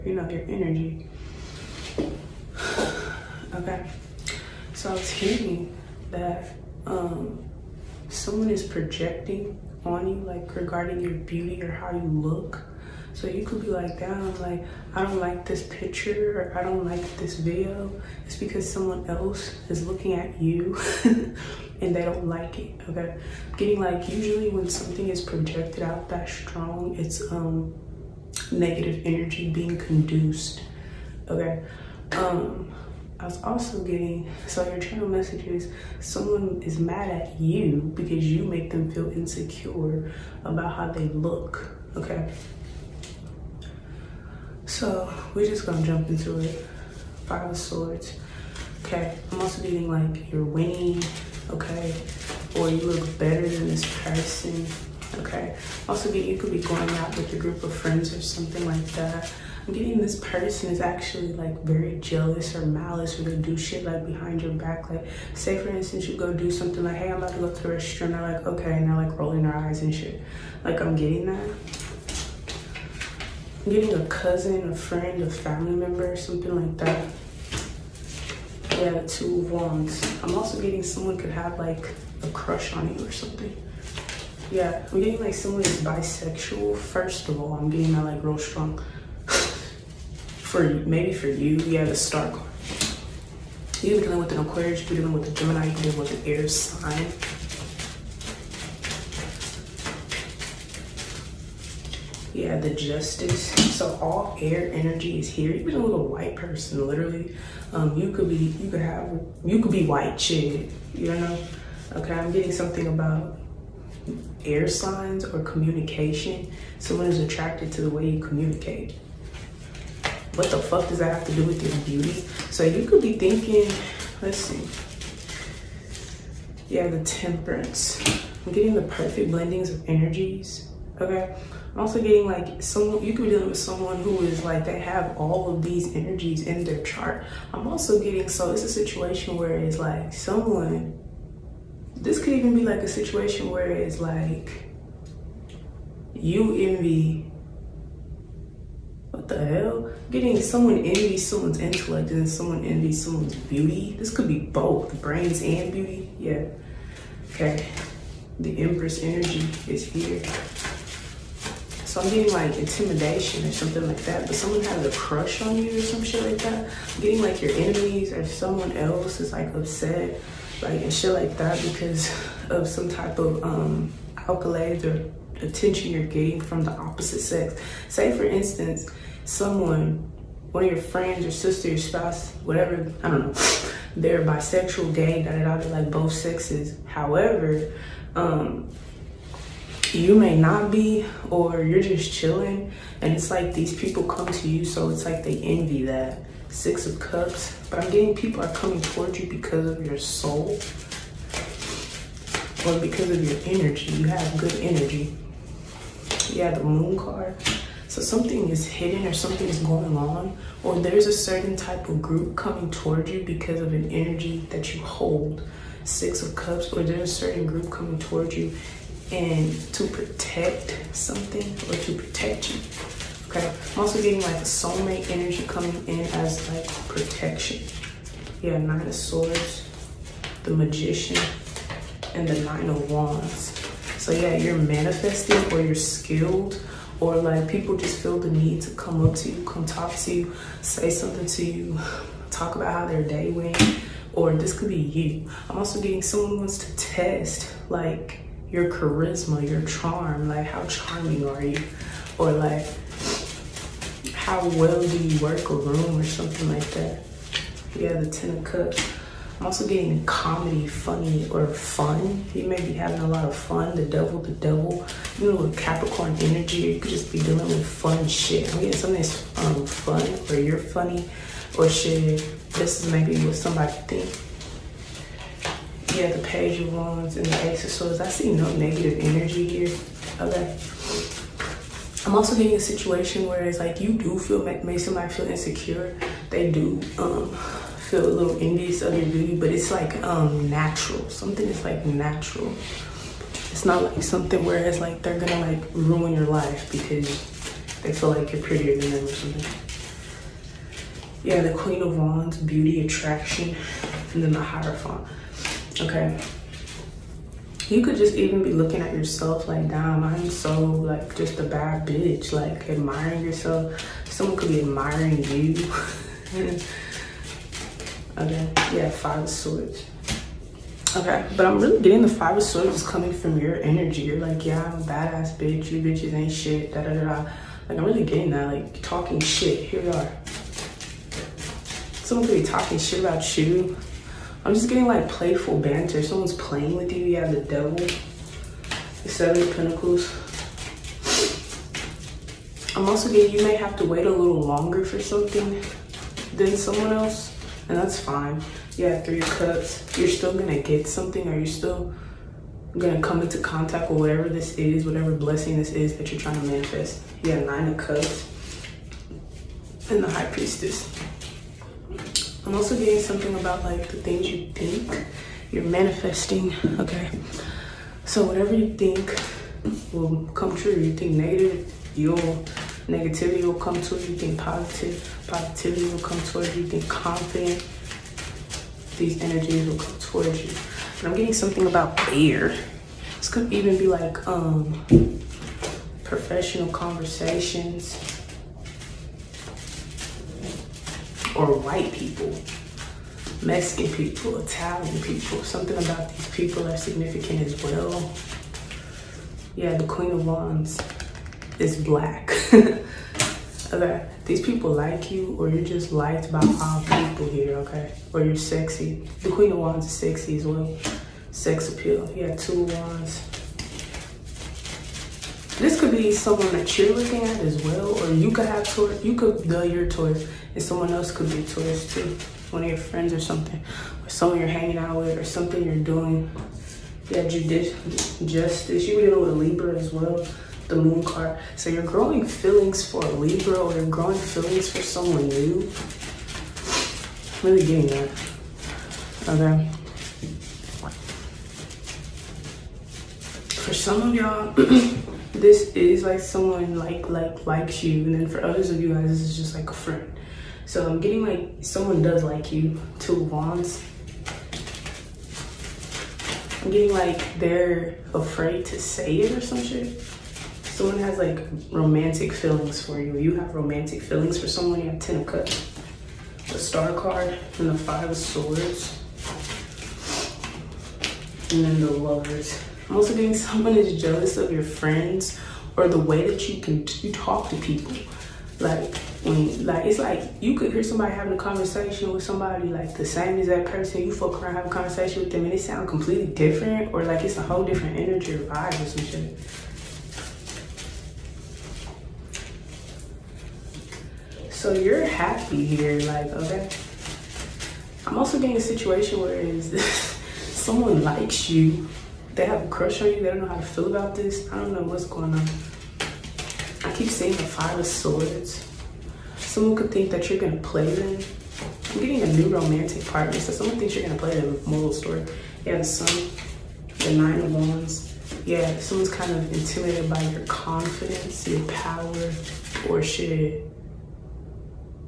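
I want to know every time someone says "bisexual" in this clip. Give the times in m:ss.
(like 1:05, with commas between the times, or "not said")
1:25, 3:04.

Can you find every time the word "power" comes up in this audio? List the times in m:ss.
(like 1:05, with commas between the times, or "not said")
8:41.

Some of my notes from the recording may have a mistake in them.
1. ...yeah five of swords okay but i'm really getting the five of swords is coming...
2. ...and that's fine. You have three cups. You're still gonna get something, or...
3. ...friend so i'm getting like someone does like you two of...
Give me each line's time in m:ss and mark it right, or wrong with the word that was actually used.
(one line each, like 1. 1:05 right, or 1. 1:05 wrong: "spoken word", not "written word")
1. 5:18 right
2. 5:47 right
3. 7:29 right.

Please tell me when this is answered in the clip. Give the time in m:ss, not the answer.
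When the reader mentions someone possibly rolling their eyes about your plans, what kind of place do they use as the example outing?
1:07.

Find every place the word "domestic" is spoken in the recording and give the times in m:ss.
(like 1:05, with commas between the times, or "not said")
not said.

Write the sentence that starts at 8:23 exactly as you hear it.
They don't know how to feel about this.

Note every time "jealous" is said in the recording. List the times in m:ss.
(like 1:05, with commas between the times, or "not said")
1:01, 7:53.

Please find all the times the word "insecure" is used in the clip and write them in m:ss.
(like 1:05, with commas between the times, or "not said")
0:39, 4:45.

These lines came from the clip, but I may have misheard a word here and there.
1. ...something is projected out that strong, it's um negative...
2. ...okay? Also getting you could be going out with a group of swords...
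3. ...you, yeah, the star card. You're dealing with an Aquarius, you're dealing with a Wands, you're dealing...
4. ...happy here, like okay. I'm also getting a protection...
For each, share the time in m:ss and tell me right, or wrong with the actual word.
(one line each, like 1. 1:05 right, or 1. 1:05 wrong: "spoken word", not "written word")
1. 0:24 right
2. 0:55 wrong: "friends", not "swords"
3. 1:31 wrong: "Gemini", not "Wands"
4. 8:15 wrong: "situation", not "protection".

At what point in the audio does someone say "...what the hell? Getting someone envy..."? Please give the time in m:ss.
2:29.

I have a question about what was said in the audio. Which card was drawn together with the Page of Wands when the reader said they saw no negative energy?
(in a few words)
Ace of Swords.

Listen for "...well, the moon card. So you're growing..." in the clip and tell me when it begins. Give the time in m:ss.
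7:09.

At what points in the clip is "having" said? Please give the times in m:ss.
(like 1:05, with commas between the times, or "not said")
4:22, 8:01.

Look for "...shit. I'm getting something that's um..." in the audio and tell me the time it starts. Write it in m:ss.
4:28.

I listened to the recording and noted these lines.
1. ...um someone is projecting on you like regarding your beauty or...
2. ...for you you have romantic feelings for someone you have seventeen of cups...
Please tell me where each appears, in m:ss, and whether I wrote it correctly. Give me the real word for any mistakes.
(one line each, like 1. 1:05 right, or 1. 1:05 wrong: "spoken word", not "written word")
1. 0:06 right
2. 7:42 wrong: "ten", not "seventeen".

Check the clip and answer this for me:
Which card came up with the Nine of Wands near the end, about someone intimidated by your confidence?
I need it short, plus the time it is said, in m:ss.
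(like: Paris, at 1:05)
The Sun, at 8:35.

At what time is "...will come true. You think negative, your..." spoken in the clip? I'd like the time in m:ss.
6:09.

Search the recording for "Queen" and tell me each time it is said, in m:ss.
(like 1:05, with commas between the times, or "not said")
5:01, 6:39, 6:49.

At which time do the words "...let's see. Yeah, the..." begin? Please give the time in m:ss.
2:04.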